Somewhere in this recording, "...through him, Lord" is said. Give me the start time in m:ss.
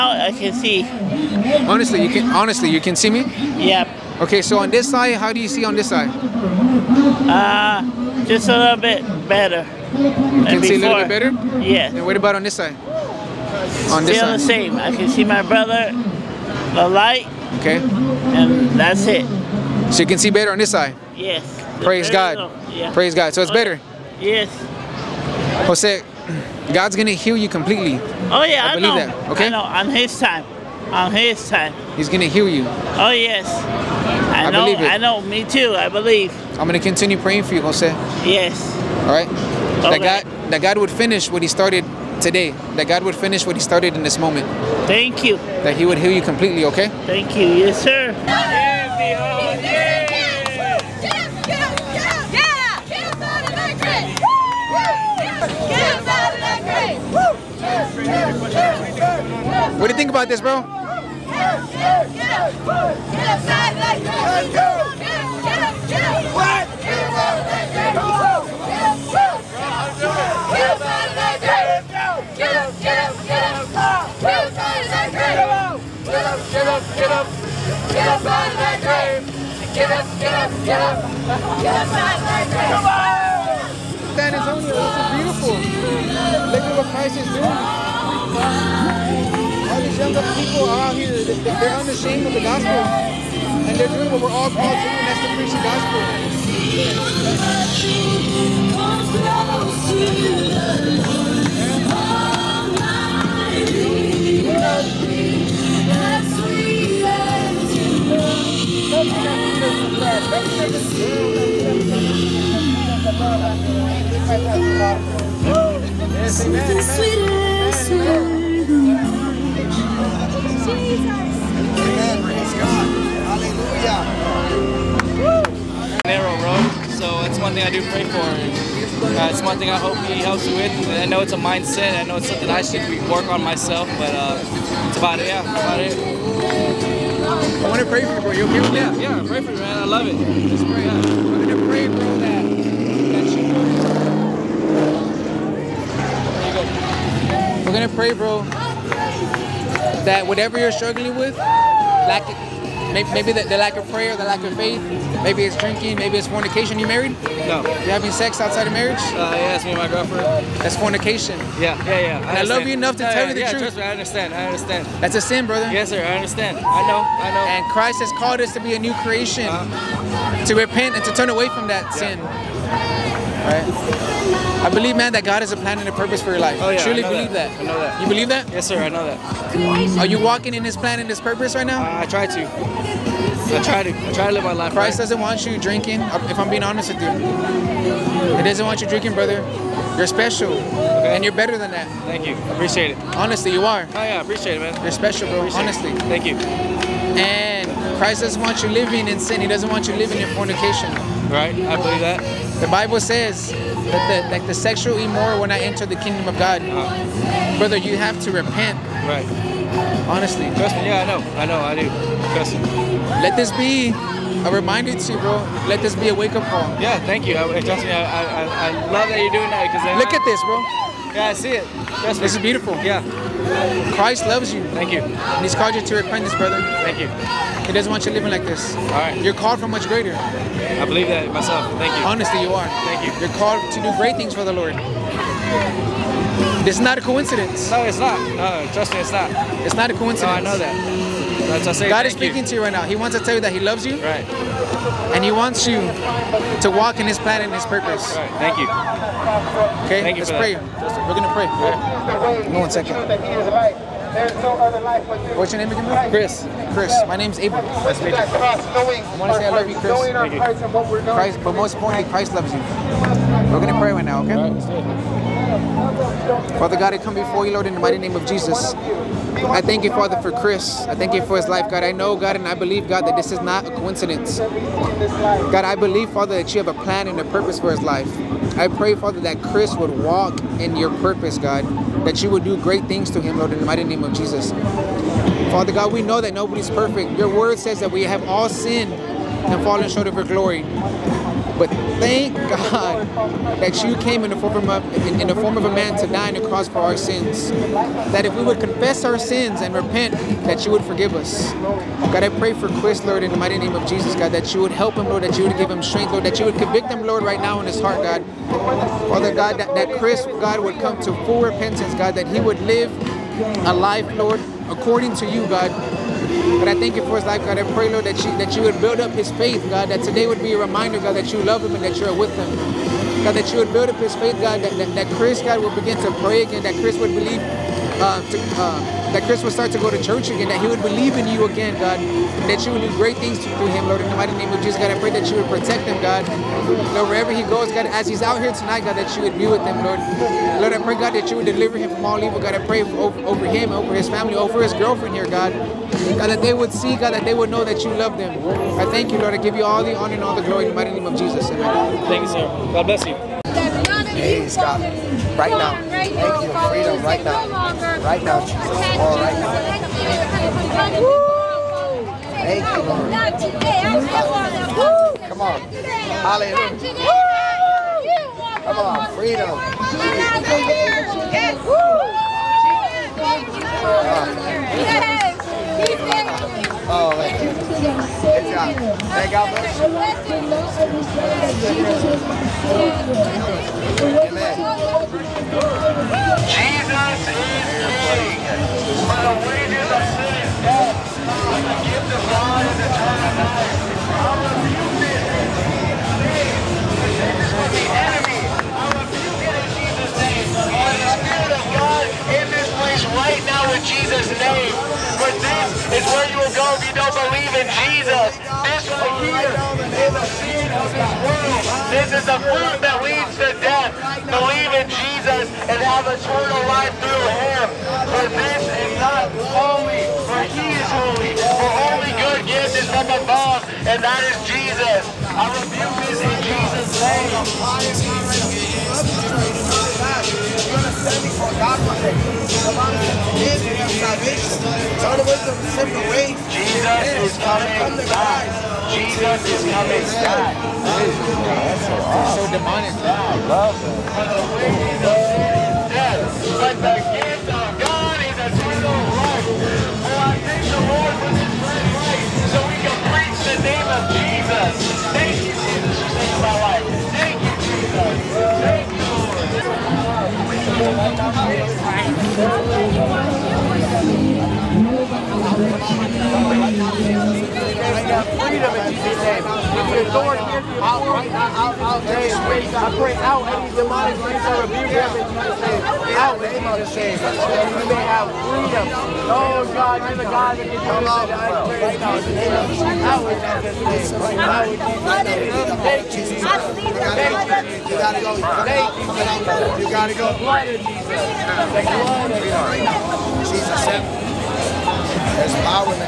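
5:33.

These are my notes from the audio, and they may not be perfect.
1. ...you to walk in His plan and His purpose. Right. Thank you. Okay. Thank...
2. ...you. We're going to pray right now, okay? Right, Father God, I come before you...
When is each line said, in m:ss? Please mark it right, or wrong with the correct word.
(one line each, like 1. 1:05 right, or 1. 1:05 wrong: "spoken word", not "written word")
1. 4:05 right
2. 4:22 right.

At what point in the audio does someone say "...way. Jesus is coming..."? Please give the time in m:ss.
7:16.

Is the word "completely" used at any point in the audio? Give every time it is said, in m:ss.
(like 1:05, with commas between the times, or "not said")
0:27, 0:46.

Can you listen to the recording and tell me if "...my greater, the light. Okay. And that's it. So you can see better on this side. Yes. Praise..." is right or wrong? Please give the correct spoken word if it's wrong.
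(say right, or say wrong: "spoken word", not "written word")
wrong: "brother", not "greater".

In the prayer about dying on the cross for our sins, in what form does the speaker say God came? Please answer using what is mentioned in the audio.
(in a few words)
A man.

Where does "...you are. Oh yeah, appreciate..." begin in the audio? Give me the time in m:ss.
3:13.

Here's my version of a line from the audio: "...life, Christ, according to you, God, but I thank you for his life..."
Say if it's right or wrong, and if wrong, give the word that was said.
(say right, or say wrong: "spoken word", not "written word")
wrong: "Lord", not "Christ".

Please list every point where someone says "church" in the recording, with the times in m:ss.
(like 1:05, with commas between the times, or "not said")
5:30.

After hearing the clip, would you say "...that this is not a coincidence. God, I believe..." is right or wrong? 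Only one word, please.
right.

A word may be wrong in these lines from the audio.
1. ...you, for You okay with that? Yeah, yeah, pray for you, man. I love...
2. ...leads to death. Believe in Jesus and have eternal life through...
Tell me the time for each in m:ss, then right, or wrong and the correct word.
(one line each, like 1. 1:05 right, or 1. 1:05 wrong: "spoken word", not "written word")
1. 2:18 right
2. 6:53 right.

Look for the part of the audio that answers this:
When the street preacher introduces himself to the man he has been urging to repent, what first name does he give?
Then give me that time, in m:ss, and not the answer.
4:17.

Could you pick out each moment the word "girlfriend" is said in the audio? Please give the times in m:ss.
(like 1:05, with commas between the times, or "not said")
2:39, 5:44.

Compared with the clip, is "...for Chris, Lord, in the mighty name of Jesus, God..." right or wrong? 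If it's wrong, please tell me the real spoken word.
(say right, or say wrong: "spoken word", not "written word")
right.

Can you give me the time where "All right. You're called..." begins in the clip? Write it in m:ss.
3:48.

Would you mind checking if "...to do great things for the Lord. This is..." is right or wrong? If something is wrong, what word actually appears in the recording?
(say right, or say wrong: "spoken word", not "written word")
right.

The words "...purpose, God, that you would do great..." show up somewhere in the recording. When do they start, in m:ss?
4:40.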